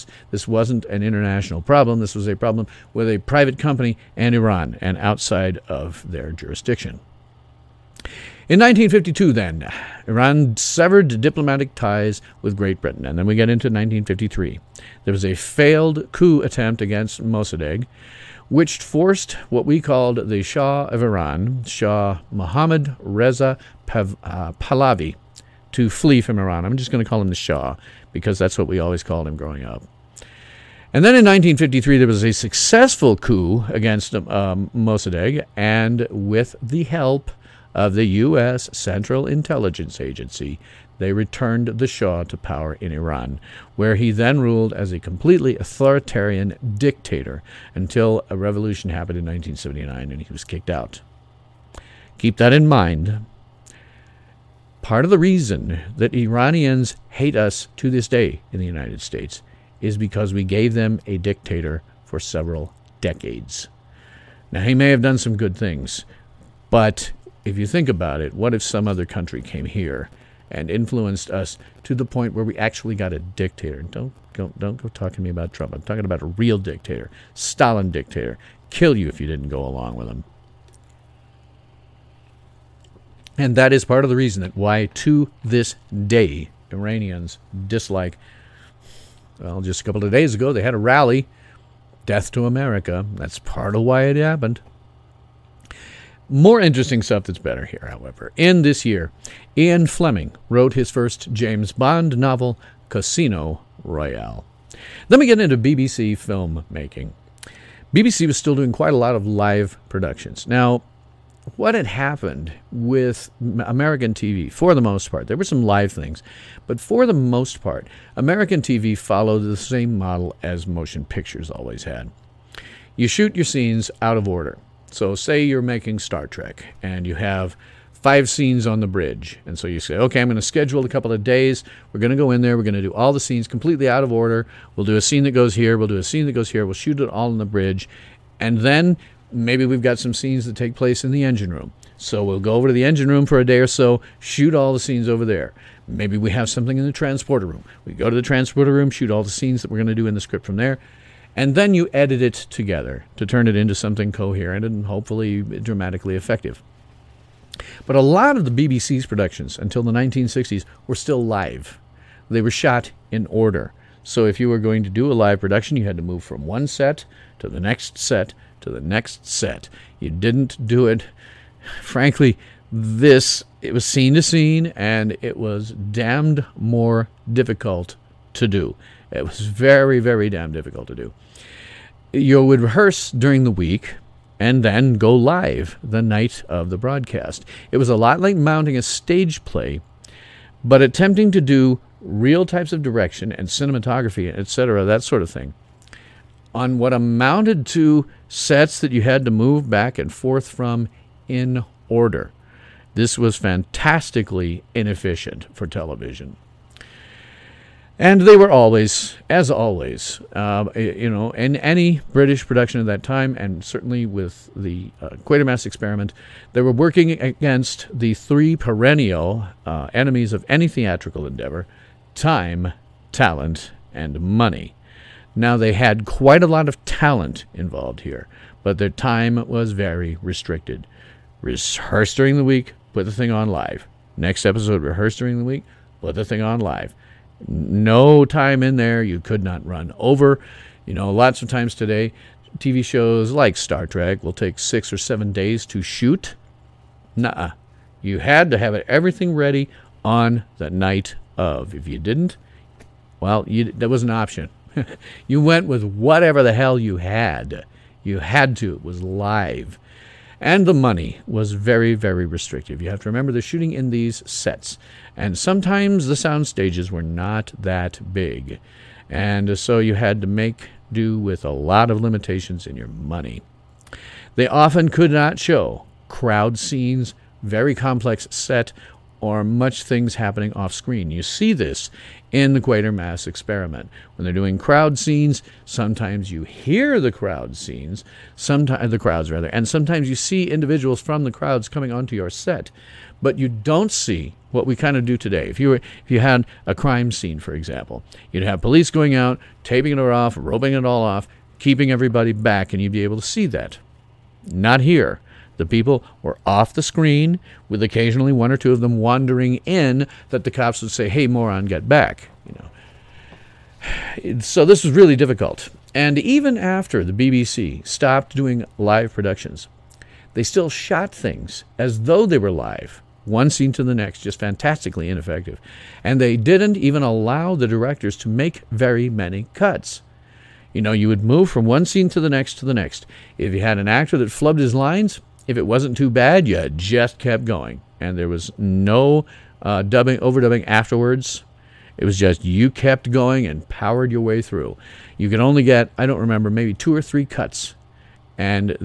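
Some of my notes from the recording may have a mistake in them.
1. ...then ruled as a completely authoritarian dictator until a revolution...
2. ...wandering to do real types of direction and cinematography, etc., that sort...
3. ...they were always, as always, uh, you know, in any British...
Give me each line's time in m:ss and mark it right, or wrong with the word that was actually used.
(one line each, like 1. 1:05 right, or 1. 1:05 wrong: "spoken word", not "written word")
1. 0:44 right
2. 3:10 wrong: "attempting", not "wandering"
3. 3:28 right.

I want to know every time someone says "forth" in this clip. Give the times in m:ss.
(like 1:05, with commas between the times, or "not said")
3:20.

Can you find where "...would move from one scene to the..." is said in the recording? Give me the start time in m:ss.
5:31.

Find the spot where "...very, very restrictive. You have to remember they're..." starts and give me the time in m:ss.
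4:21.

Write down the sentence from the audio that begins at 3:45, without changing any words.
Now, they had quite a lot of talent involved here, but their time was very restricted.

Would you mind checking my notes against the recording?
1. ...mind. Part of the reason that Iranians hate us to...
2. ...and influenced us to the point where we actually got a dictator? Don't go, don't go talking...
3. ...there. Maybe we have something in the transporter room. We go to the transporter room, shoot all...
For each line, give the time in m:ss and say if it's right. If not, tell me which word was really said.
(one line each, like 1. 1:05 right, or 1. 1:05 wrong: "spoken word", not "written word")
1. 0:52 right
2. 1:10 right
3. 2:25 right.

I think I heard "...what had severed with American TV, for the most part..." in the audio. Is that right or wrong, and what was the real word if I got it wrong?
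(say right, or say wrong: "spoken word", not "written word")
wrong: "happened", not "severed".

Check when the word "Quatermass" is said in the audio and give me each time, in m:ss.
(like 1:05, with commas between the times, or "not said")
3:35, 4:42.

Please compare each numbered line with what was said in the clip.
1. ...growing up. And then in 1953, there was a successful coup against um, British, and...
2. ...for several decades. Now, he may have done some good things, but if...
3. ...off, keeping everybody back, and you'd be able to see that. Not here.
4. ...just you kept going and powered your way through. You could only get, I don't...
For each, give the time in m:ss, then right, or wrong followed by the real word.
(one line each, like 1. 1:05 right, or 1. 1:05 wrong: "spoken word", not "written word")
1. 0:29 wrong: "Mossadegh", not "British"
2. 1:02 right
3. 5:01 right
4. 5:42 right.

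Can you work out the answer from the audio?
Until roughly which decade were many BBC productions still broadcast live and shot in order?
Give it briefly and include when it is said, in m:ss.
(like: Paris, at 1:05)
1960s, at 2:39.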